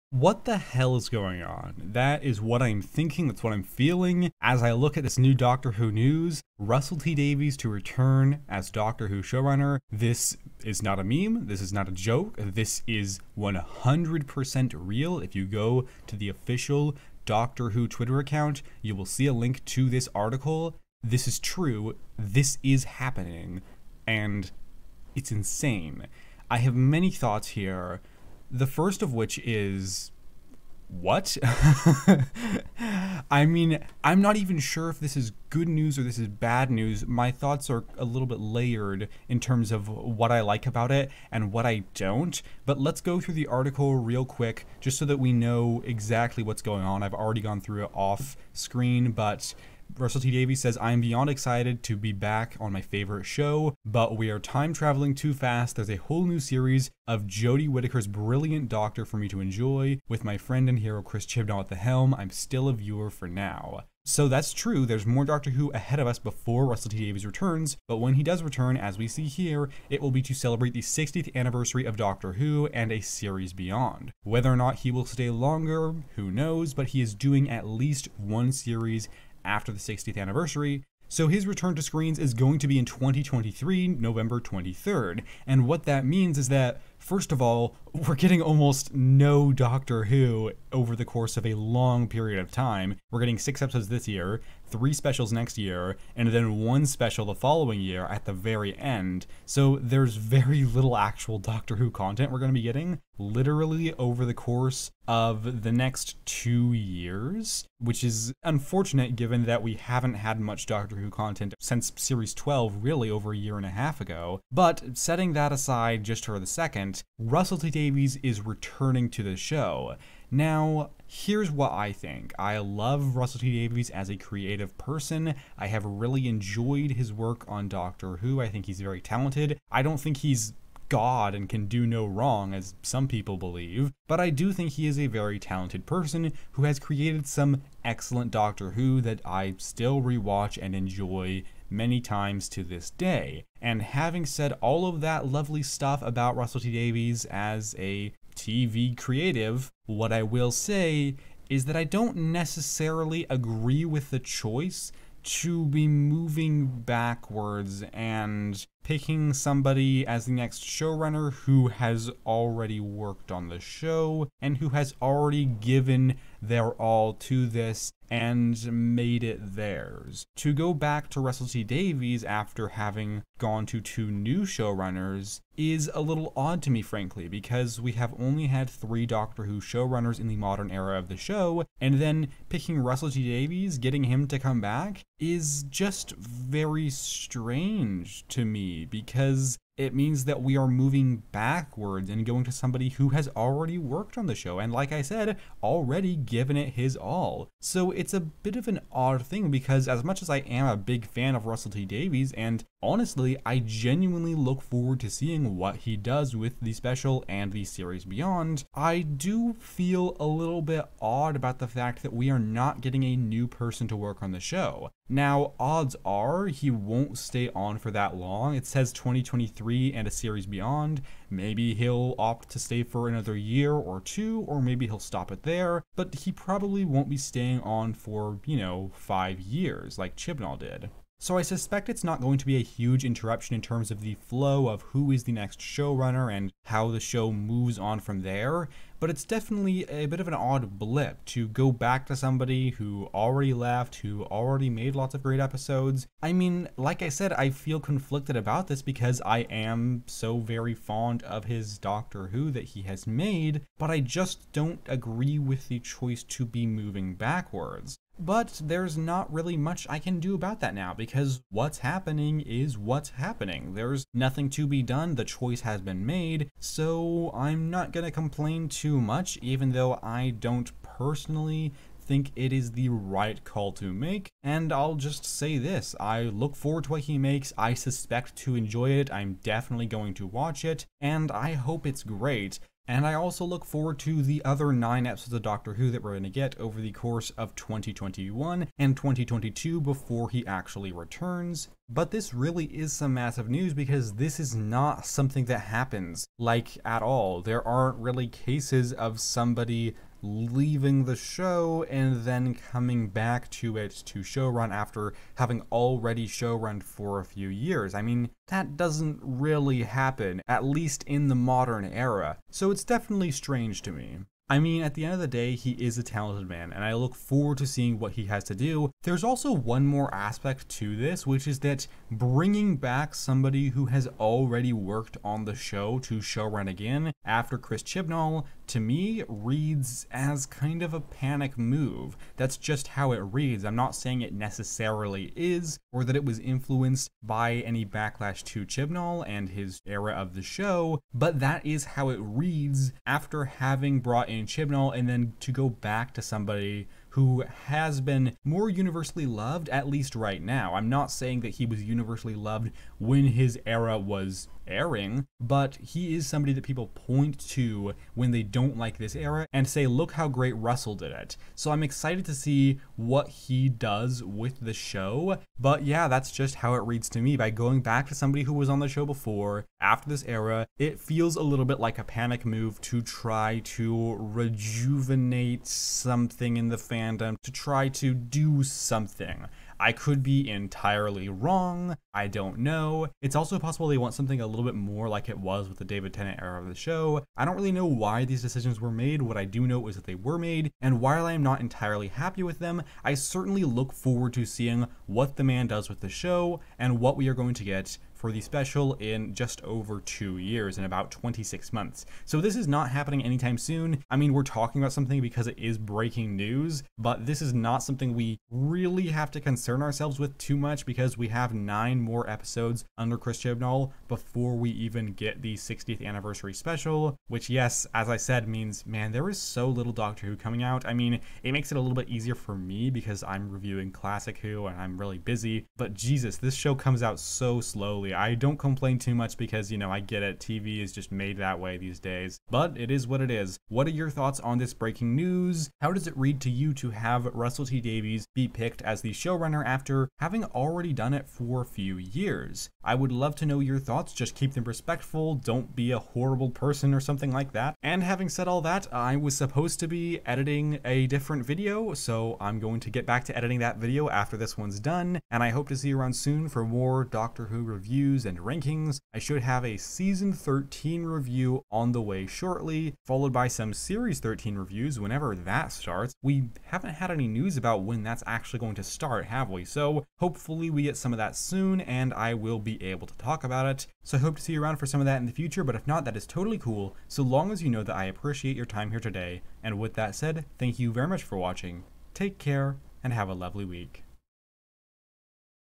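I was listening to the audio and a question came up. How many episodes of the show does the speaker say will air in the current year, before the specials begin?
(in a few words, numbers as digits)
6.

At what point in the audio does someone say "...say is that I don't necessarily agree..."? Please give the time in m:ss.
2:30.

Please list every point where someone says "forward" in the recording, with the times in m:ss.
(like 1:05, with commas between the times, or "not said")
3:24, 4:36, 4:43, 5:17, 6:33.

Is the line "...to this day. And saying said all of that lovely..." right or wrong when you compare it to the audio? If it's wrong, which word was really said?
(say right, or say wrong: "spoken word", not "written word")
wrong: "having", not "saying".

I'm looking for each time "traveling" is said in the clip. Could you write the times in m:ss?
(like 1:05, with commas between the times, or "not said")
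0:54.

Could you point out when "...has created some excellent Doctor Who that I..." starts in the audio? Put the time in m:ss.
2:16.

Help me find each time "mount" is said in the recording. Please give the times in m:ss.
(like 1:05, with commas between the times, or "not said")
not said.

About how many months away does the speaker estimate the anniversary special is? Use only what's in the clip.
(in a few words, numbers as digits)
26.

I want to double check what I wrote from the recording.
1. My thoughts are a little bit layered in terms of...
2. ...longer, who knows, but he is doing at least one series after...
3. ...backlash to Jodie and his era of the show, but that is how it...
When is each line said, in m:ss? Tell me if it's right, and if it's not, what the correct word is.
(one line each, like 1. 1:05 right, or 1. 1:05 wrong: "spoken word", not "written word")
1. 0:37 right
2. 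1:15 right
3. 5:37 wrong: "Chibnall", not "Jodie".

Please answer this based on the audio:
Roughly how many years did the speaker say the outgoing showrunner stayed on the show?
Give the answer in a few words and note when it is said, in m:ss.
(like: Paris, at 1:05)
5, at 3:48.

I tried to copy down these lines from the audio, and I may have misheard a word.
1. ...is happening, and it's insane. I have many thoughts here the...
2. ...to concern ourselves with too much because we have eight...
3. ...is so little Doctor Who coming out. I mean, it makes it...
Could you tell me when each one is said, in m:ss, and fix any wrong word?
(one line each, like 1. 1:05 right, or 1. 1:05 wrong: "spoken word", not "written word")
1. 0:22 right
2. 6:49 wrong: "nine", not "eight"
3. 6:59 right.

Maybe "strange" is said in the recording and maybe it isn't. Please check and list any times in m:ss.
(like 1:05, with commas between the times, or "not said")
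3:06, 5:13.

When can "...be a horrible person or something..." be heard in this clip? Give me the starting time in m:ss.
7:25.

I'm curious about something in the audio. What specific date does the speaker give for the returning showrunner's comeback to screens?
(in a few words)
November 23rd.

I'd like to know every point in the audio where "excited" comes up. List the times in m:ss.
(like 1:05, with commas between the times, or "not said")
0:51, 6:01.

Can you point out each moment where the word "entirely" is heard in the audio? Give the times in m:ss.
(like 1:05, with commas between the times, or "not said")
6:20, 6:31.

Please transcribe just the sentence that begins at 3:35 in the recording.
Now, odds are he won't stay on for that long.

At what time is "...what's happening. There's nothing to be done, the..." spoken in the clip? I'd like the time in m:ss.
4:22.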